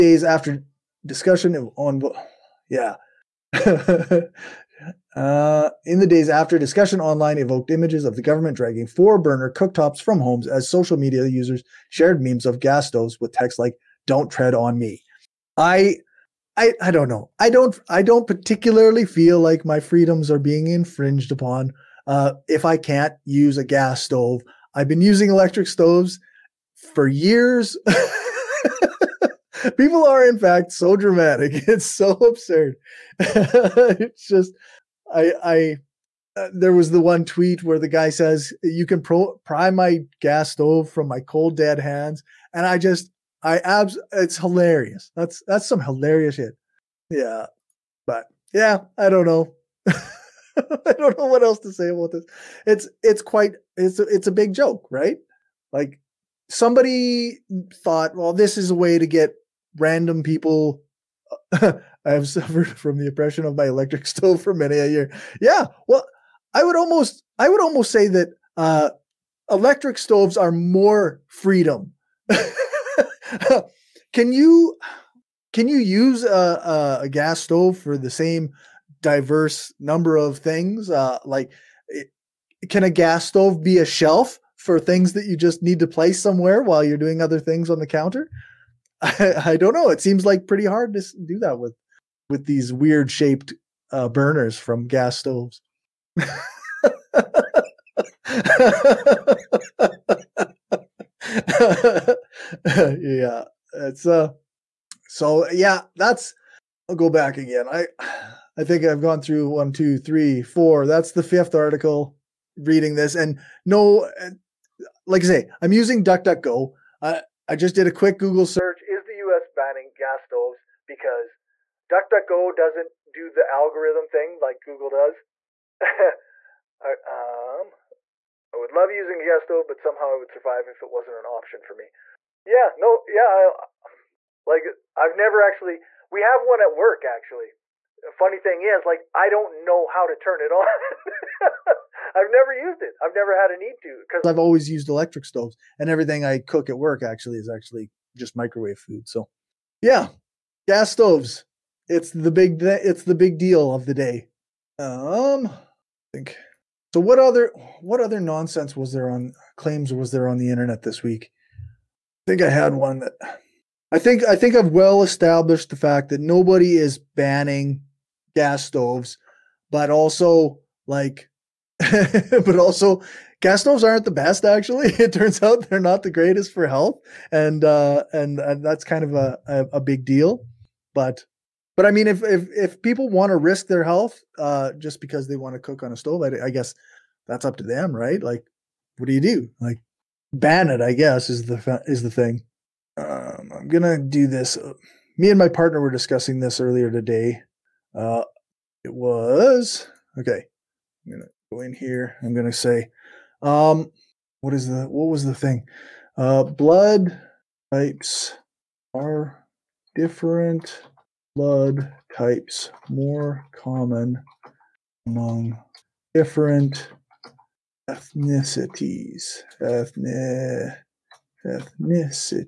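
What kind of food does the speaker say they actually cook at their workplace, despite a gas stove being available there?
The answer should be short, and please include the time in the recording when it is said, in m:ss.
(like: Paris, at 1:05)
Microwave food, at 2:28.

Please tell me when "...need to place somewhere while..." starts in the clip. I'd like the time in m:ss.
1:25.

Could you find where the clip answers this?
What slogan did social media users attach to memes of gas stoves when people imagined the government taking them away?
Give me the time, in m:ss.
0:14.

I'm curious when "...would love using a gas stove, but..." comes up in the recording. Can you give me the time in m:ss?
2:08.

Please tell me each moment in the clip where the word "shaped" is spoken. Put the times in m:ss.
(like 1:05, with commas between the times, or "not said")
1:33.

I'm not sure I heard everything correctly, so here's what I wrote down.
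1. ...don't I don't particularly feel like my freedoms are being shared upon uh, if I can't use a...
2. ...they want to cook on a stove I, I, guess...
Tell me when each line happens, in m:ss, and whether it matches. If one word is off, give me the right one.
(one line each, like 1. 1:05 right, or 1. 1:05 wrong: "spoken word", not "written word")
1. 0:17 wrong: "infringed", not "shared"
2. 3:05 right.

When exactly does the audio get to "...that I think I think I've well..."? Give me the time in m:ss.
2:42.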